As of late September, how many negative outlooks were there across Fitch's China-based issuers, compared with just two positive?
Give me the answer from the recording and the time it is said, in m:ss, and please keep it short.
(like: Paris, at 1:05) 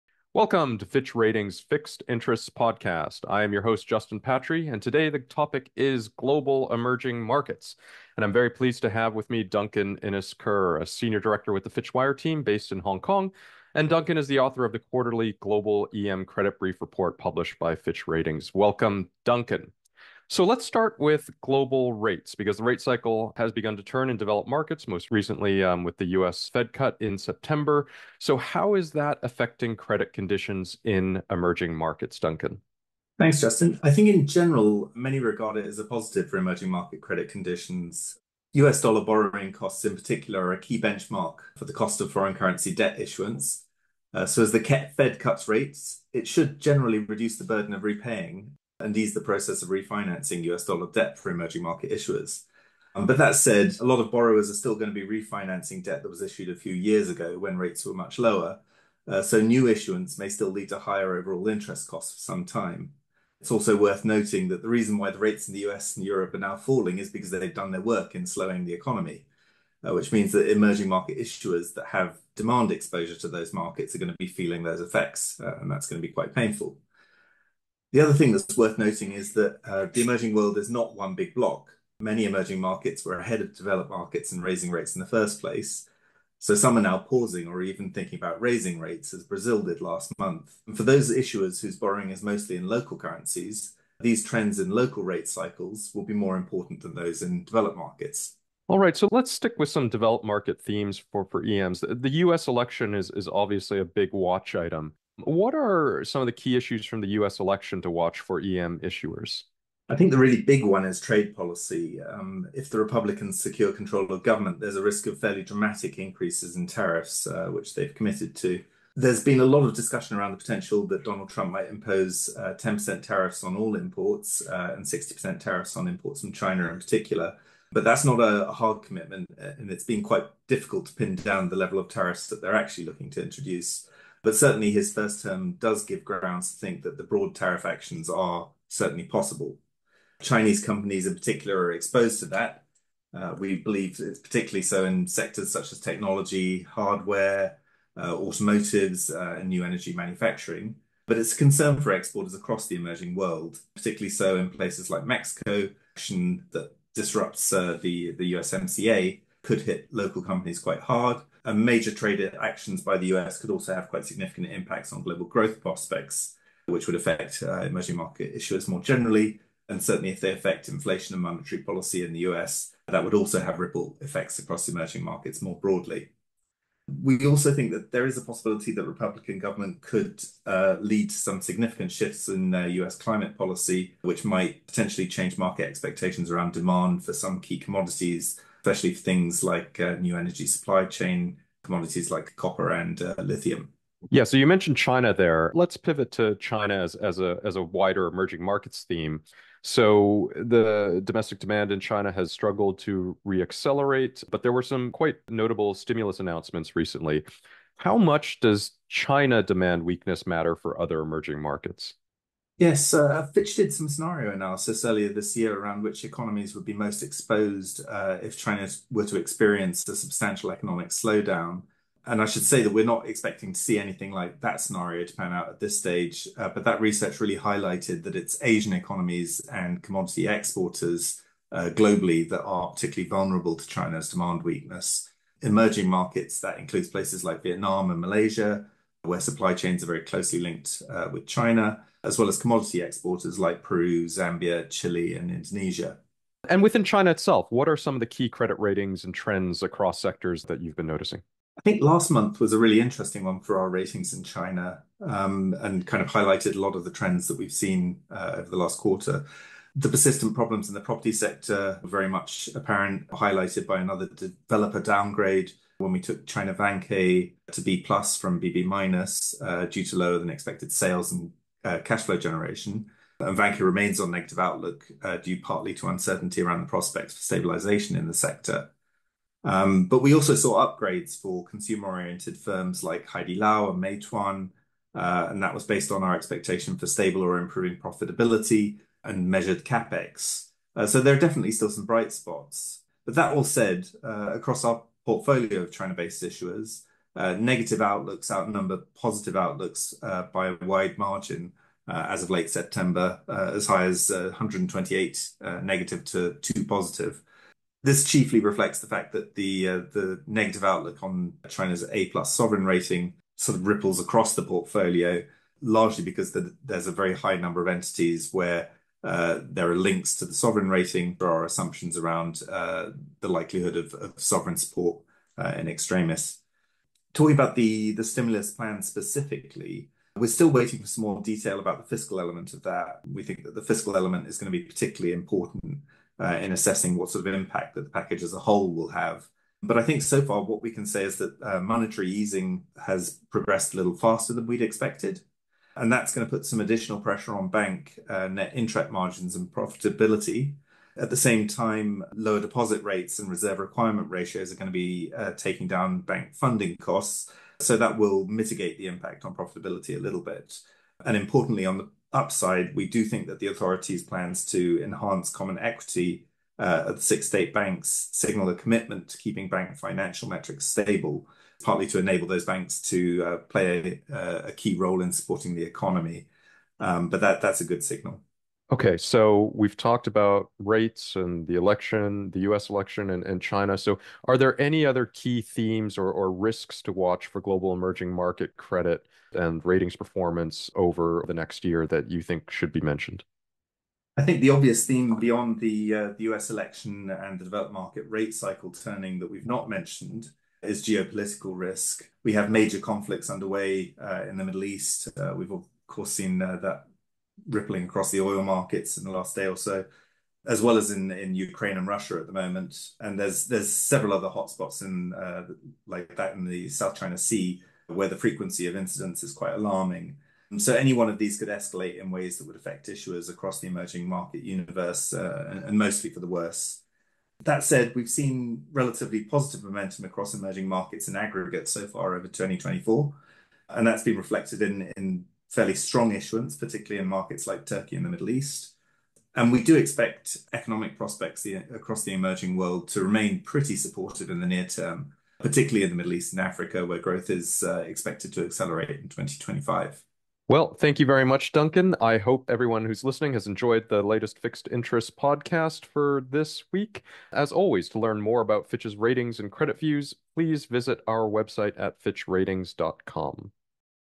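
128, at 5:04.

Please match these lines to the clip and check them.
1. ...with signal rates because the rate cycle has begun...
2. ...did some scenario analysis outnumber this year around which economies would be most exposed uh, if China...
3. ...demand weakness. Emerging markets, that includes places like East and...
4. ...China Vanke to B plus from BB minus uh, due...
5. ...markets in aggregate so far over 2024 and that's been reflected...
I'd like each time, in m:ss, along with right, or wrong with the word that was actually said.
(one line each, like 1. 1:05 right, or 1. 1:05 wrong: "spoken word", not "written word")
1. 0:20 wrong: "global", not "signal"
2. 3:33 wrong: "earlier", not "outnumber"
3. 3:54 wrong: "Vietnam", not "East"
4. 4:26 right
5. 7:10 right.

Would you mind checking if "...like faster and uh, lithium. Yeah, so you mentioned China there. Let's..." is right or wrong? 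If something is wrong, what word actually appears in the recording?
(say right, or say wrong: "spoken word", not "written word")
wrong: "copper", not "faster".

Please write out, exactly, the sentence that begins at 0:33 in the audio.
I think in general, many regard it as a positive for emerging market credit conditions.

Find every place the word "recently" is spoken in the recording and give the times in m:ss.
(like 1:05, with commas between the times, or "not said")
0:25, 3:26.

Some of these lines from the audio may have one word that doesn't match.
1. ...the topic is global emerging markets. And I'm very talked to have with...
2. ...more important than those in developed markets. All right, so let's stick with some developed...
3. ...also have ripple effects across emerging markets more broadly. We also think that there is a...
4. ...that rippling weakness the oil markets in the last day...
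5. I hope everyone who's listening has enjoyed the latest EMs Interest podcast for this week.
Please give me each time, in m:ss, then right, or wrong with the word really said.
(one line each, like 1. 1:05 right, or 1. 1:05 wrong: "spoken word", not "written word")
1. 0:05 wrong: "pleased", not "talked"
2. 1:36 right
3. 2:53 right
4. 6:46 wrong: "across", not "weakness"
5. 7:32 wrong: "Fixed", not "EMs".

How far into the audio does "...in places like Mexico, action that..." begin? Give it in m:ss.
2:34.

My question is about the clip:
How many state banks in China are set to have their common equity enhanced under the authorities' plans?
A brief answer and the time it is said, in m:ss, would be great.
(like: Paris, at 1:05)
6, at 6:07.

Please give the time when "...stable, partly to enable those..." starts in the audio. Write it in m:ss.
6:10.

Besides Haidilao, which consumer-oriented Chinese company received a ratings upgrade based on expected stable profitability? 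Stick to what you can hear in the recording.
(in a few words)
Meituan.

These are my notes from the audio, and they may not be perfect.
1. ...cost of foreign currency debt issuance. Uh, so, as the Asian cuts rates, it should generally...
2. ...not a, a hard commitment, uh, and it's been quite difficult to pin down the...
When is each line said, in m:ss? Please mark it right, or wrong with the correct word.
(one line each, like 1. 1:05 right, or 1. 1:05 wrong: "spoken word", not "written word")
1. 0:41 wrong: "Fed", not "Asian"
2. 2:08 right.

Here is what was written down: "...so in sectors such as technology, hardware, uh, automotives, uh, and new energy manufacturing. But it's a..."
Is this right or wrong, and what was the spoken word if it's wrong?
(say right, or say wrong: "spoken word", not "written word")
right.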